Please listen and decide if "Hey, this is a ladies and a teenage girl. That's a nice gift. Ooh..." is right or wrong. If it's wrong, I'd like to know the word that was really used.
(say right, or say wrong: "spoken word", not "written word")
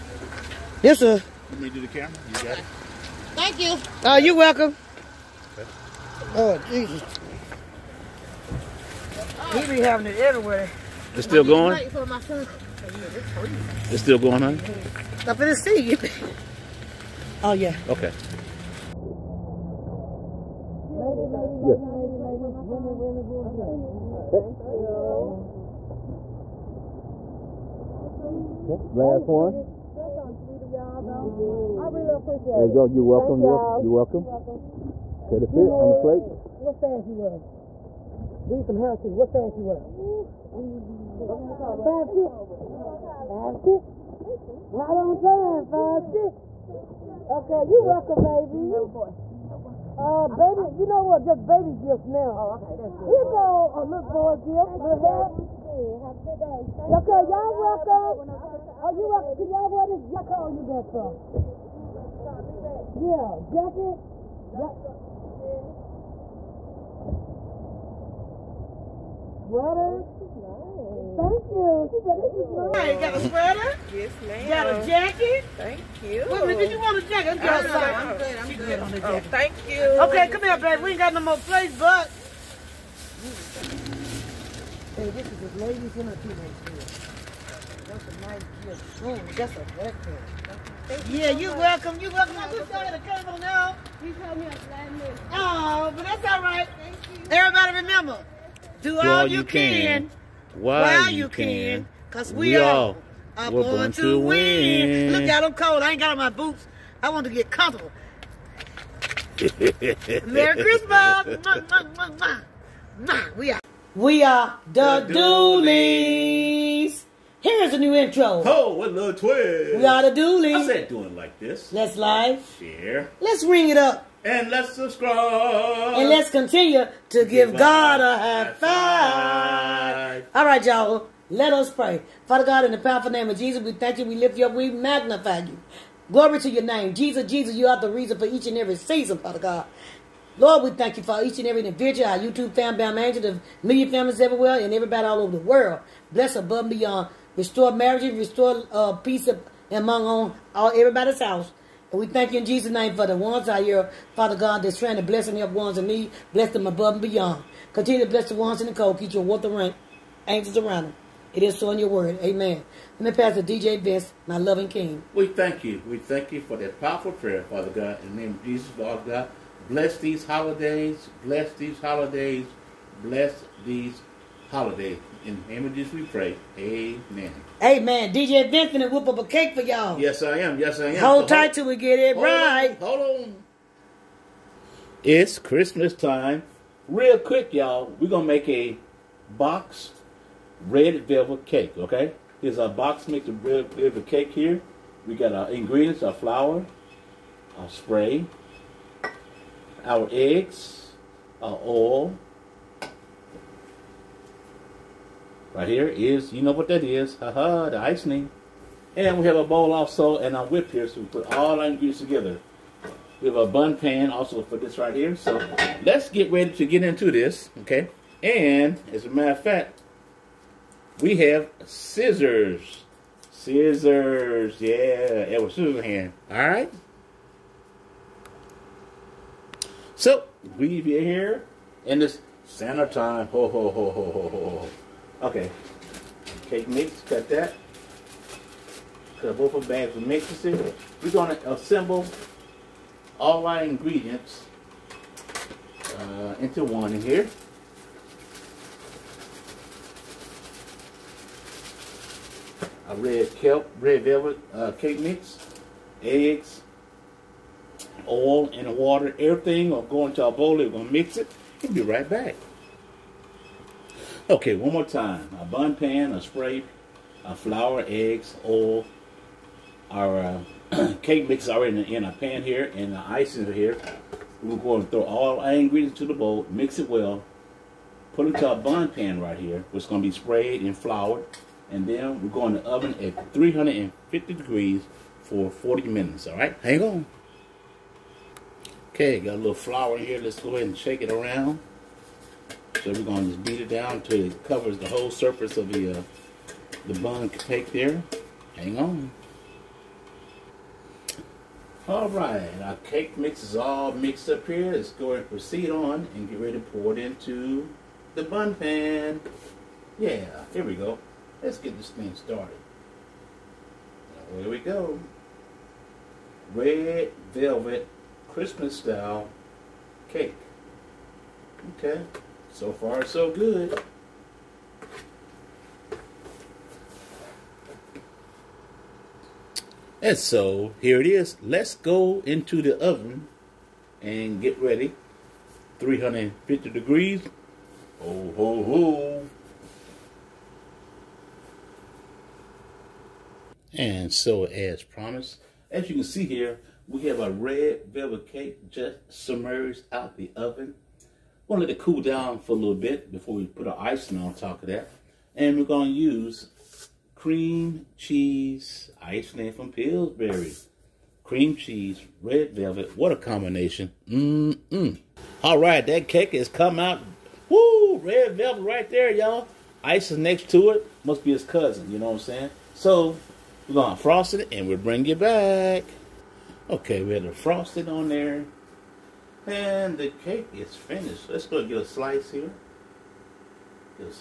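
right.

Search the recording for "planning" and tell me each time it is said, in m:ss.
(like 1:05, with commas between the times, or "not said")
not said.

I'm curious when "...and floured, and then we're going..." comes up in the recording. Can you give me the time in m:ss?
4:40.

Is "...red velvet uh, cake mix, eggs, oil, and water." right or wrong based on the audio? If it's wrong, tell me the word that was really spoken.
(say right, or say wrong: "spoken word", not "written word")
right.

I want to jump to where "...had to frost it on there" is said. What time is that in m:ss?
6:17.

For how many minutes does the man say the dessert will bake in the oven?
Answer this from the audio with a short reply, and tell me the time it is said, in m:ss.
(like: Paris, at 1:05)
40 minutes, at 4:45.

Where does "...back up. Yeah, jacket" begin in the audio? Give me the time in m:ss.
1:00.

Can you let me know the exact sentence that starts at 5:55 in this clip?
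And we're going to use cream cheese icing from Pillsbury.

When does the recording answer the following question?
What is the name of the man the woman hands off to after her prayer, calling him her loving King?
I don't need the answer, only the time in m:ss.
2:43.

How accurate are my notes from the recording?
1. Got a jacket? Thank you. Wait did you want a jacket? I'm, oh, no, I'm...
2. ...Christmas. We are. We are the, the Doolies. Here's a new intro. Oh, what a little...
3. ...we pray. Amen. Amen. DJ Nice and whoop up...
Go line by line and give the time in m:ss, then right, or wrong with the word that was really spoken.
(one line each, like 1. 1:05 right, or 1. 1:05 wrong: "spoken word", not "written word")
1. 1:14 right
2. 1:50 right
3. 2:55 wrong: "Vincent", not "Nice".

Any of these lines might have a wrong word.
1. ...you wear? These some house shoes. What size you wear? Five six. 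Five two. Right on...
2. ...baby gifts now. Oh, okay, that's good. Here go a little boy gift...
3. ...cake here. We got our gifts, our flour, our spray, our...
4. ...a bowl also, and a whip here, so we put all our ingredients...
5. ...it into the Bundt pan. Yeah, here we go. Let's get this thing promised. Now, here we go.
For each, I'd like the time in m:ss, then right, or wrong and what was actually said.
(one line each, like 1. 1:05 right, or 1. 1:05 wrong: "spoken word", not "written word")
1. 0:37 wrong: "six", not "two"
2. 0:51 right
3. 3:14 wrong: "ingredients", not "gifts"
4. 3:29 right
5. 5:06 wrong: "started", not "promised".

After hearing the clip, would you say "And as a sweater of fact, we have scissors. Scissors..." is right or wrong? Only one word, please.
wrong.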